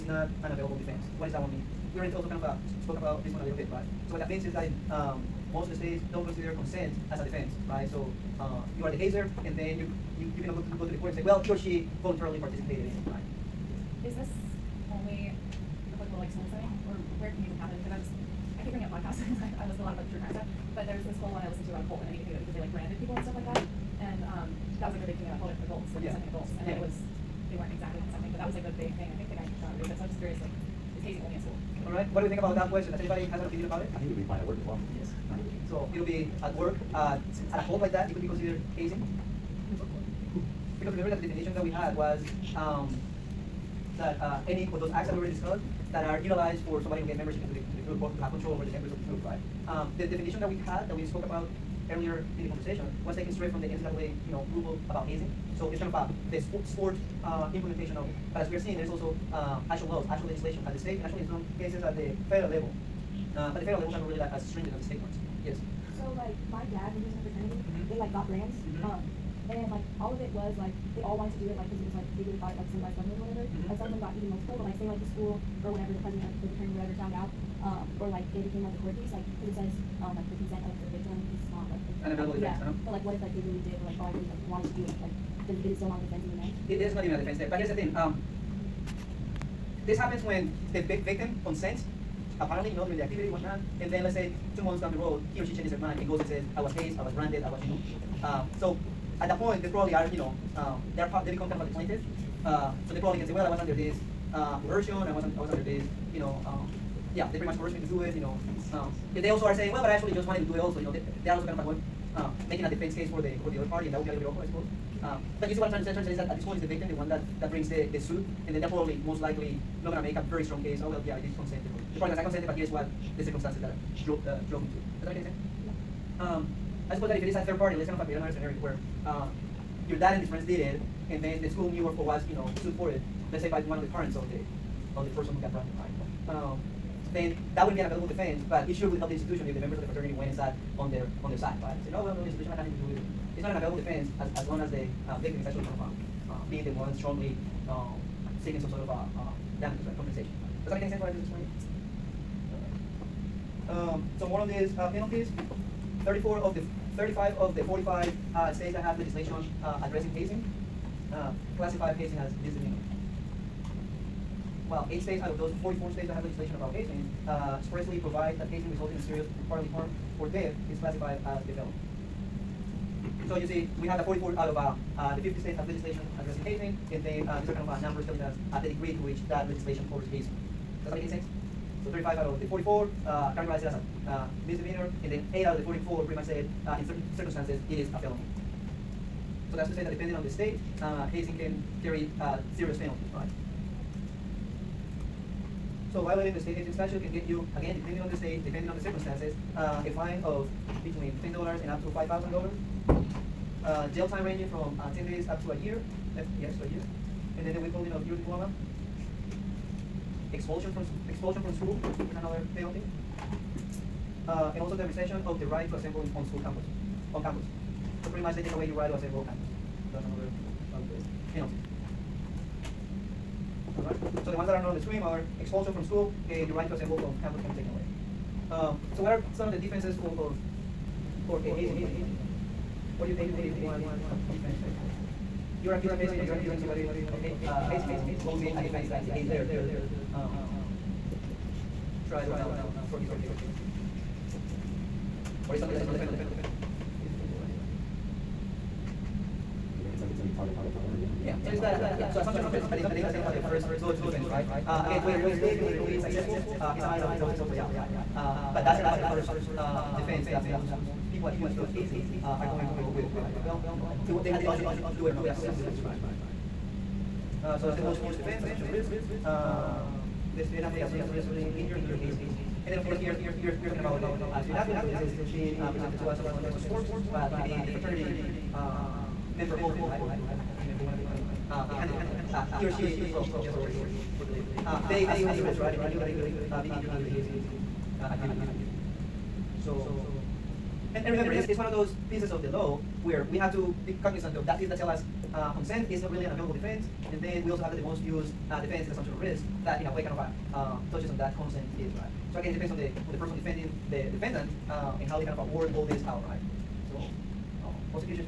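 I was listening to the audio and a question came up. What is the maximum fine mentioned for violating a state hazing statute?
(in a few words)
$5,000.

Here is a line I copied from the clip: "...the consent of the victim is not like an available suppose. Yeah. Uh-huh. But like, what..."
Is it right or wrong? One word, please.
wrong.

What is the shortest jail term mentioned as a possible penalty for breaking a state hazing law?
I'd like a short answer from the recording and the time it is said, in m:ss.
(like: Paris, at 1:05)
10 days, at 3:24.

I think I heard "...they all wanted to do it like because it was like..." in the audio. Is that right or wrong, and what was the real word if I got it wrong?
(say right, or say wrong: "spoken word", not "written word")
right.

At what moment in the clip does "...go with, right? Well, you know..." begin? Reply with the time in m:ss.
4:22.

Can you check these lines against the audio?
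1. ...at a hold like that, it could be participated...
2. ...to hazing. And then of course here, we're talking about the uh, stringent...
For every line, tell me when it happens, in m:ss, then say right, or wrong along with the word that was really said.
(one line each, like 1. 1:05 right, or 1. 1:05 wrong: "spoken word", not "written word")
1. 0:37 wrong: "considered", not "participated"
2. 4:31 wrong: "student", not "stringent".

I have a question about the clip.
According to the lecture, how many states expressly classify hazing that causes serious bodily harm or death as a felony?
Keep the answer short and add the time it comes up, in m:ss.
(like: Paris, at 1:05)
8, at 2:44.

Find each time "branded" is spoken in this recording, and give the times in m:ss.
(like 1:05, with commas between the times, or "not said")
1:37, 2:15.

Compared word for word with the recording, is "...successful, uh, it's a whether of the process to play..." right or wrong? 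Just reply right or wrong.
wrong.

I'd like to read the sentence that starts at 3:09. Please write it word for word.
So that's to say that depending on the state, uh, hazing can carry uh, serious penalties, right?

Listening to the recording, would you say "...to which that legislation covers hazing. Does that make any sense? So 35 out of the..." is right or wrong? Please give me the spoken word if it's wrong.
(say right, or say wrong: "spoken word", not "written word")
right.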